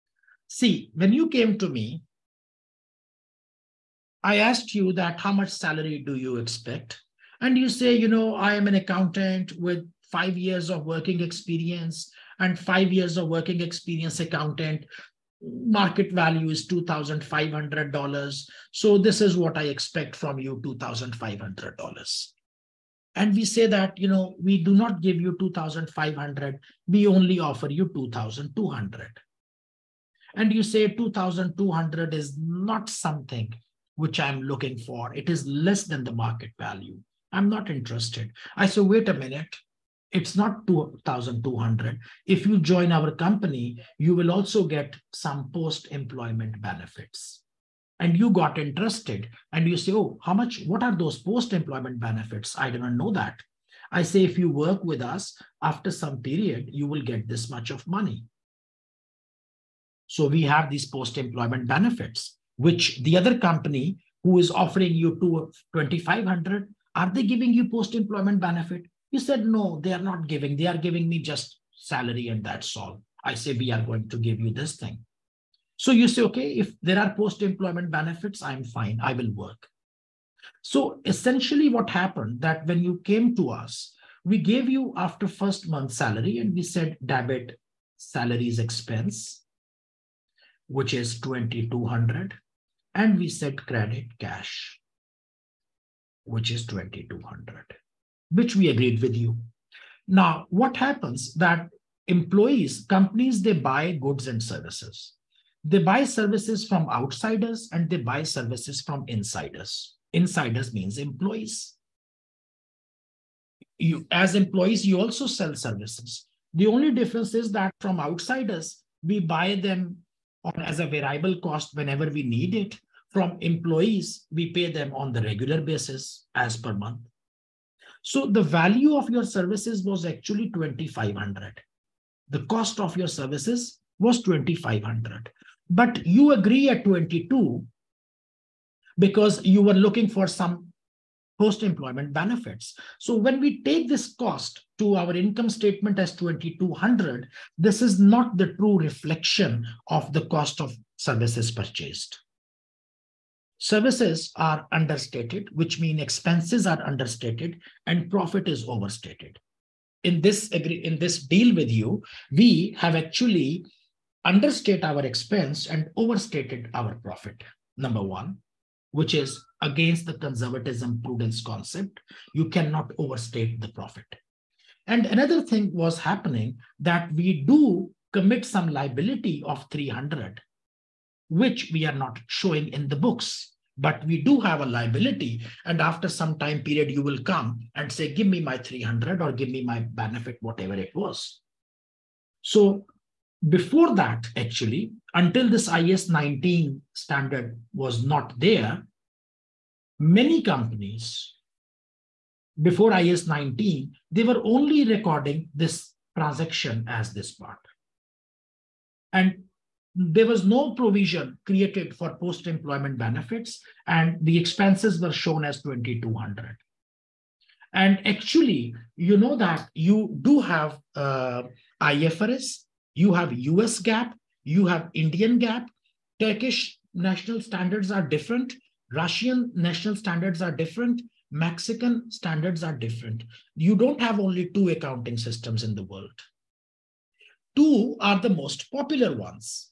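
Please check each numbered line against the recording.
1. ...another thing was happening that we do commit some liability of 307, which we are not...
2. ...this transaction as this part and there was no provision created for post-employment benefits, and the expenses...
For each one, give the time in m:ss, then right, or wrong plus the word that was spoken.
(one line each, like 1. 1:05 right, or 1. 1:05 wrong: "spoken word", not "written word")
1. 2:55 wrong: "300", not "307"
2. 3:25 right.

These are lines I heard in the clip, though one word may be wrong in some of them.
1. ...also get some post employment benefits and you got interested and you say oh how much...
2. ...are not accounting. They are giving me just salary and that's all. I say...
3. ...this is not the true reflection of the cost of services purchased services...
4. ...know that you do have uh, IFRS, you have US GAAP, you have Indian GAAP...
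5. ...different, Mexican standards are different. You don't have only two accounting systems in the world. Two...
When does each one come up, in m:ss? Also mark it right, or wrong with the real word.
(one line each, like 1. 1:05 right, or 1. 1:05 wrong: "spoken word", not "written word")
1. 0:44 right
2. 1:09 wrong: "giving", not "accounting"
3. 2:27 right
4. 3:39 right
5. 3:50 right.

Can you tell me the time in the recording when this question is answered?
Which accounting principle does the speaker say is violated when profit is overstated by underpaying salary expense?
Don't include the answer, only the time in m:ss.
2:50.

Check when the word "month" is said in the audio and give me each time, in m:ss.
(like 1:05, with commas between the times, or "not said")
1:25, 2:06.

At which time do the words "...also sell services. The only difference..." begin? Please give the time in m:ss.
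1:54.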